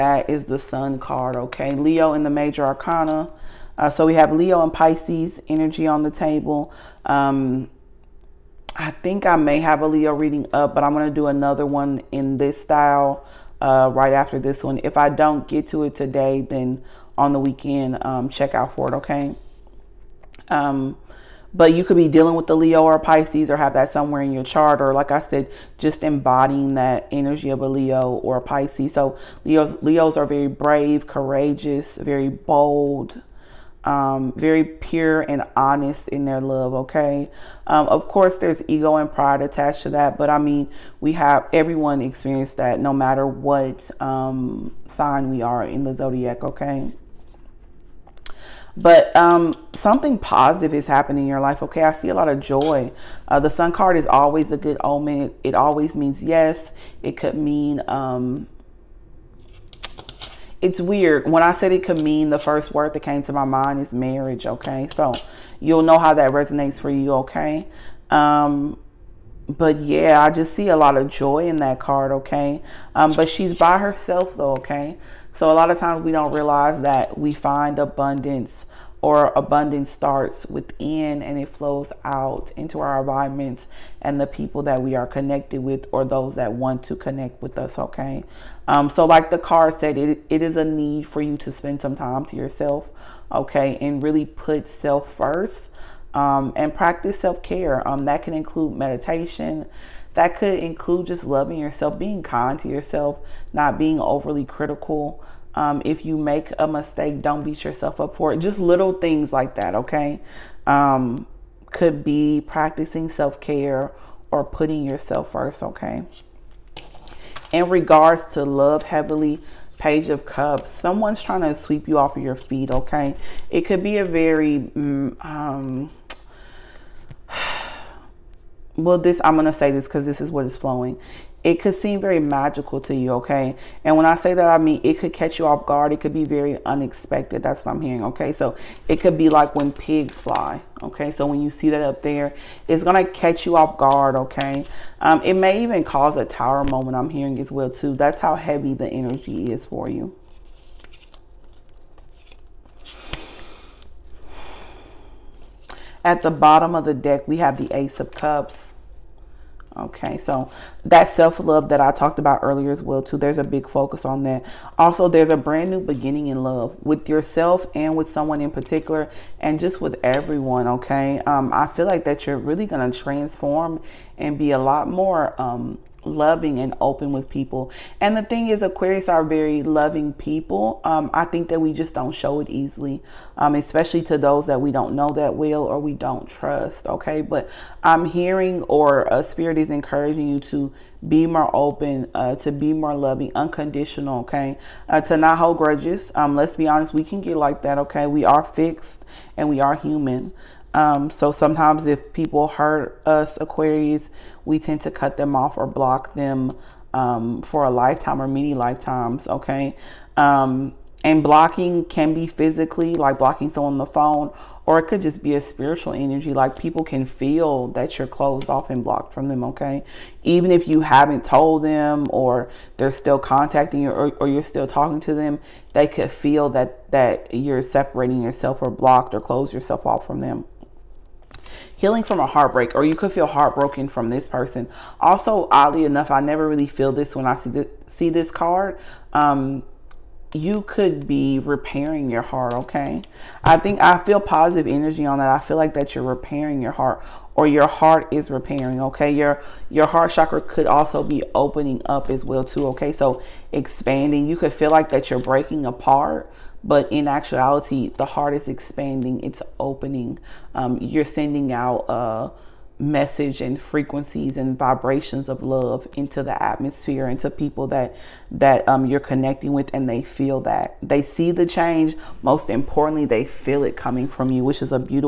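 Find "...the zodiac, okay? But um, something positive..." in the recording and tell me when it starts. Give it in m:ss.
0:45.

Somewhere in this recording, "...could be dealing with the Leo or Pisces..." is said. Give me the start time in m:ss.
0:21.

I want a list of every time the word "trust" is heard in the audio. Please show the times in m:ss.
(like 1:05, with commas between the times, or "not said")
3:06.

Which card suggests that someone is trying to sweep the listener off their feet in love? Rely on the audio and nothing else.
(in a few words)
Page of Cups.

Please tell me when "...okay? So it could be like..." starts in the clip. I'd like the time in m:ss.
2:18.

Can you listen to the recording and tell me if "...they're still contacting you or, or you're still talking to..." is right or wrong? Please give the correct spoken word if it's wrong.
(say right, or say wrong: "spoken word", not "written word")
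right.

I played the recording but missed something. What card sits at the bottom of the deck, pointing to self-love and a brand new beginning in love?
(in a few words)
Ace of Cups.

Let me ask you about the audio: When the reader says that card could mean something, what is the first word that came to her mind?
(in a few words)
Marriage.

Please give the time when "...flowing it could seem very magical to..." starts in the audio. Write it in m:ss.
2:10.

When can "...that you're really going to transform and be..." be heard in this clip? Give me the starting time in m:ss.
2:52.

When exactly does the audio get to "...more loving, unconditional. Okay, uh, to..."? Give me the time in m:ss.
3:12.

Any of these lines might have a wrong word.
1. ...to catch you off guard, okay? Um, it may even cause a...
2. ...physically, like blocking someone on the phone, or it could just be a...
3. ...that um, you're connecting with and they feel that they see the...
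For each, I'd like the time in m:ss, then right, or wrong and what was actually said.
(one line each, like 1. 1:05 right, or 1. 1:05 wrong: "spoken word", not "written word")
1. 2:23 right
2. 3:32 right
3. 4:28 right.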